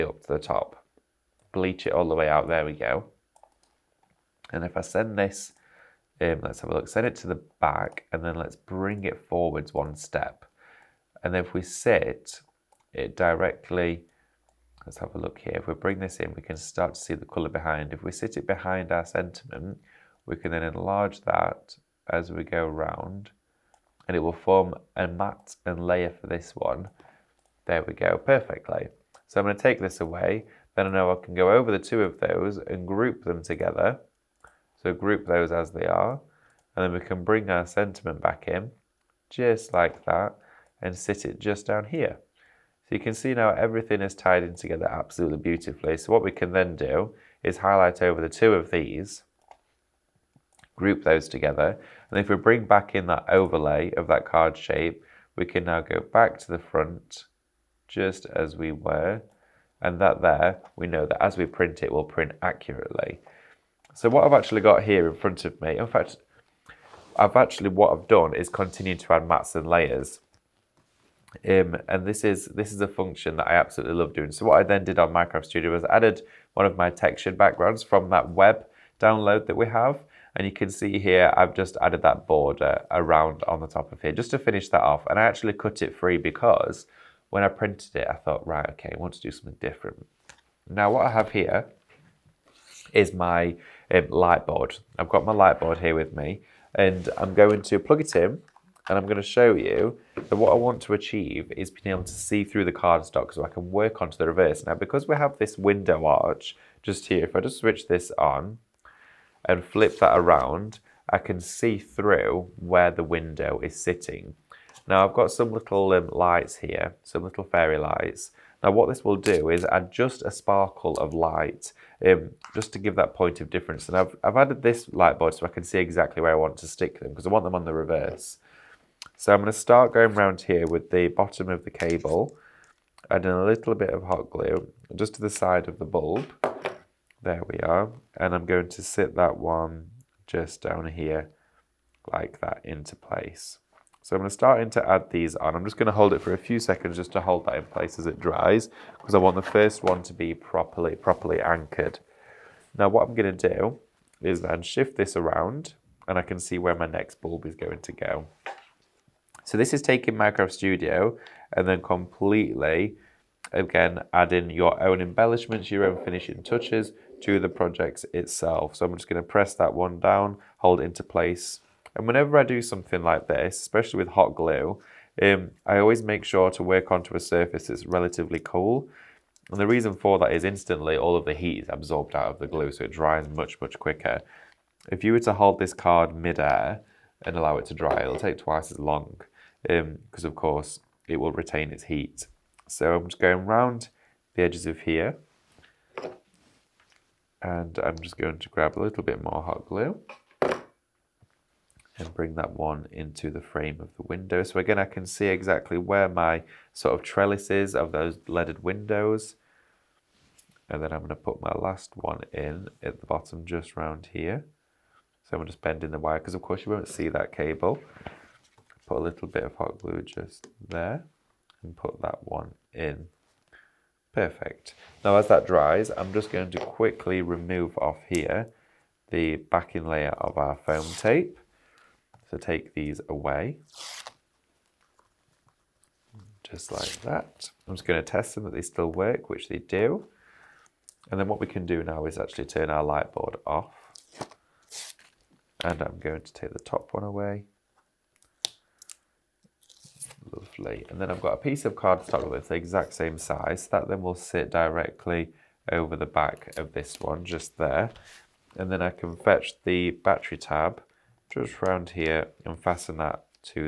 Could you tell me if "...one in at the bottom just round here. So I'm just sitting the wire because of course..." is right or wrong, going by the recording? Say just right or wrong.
wrong.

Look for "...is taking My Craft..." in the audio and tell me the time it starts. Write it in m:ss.
2:39.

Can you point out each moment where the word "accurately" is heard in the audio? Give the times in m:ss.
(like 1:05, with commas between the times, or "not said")
1:02.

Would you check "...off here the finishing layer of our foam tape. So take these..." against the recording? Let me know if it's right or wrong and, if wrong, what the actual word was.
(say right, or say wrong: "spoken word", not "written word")
wrong: "backing", not "finishing".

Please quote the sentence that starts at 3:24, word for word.
So again, I can see exactly where my sort of trellis is of those leaded windows.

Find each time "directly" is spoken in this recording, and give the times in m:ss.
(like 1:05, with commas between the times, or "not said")
0:13, 4:14.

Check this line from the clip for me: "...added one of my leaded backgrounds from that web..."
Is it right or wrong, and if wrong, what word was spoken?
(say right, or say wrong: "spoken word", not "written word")
wrong: "textured", not "leaded".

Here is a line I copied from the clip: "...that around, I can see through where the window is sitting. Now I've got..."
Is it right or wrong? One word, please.
right.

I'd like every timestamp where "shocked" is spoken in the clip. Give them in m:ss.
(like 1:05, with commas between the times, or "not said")
not said.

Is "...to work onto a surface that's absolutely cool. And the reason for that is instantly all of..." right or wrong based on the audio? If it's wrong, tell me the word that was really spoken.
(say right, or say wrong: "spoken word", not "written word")
wrong: "relatively", not "absolutely".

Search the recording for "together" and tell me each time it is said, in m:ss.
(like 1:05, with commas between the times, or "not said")
0:33, 0:44, 0:51.